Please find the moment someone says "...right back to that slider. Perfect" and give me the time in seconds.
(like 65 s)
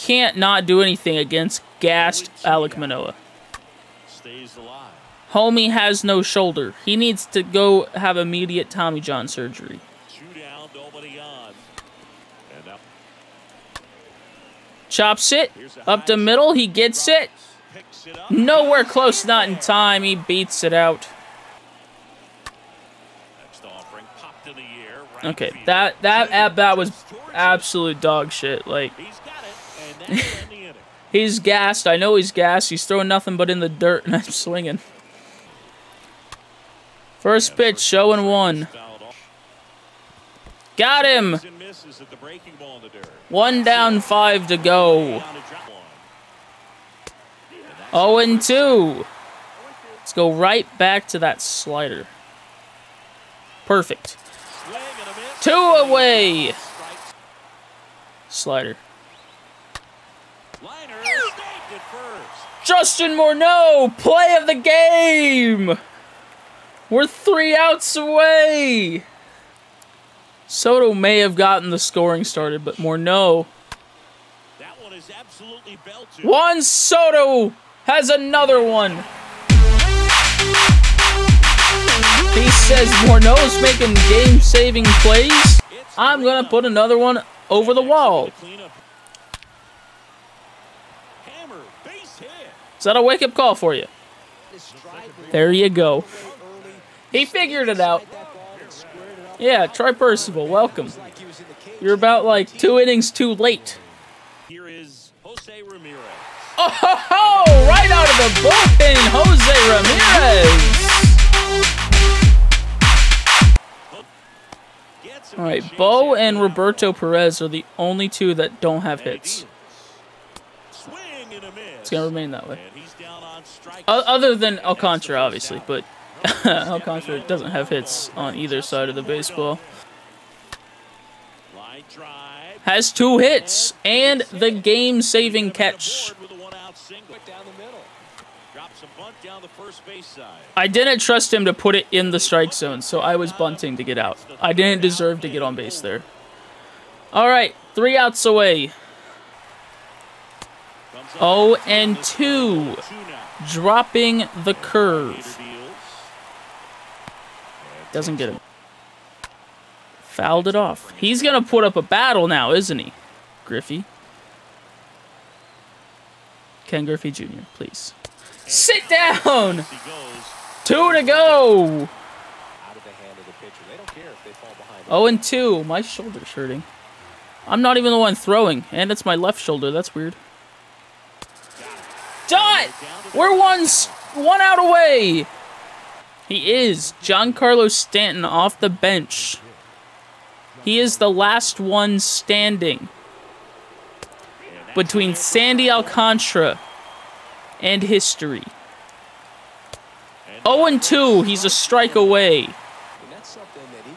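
50 s.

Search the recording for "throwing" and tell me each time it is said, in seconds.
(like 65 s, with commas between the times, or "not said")
32 s, 178 s.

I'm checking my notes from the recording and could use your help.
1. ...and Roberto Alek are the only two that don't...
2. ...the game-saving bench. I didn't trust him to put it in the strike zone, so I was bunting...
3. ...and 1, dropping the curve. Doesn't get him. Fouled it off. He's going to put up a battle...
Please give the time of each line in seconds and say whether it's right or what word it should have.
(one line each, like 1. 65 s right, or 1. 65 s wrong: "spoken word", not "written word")
1. 116 s wrong: "Perez", not "Alek"
2. 134 s wrong: "catch", not "bench"
3. 151 s wrong: "2", not "1".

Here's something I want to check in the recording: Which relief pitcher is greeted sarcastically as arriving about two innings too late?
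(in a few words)
Percival.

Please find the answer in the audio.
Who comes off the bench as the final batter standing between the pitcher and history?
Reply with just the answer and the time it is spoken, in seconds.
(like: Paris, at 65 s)
Giancarlo Stanton, at 187 s.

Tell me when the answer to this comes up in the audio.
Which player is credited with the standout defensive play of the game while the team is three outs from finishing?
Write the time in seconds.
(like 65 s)
62 s.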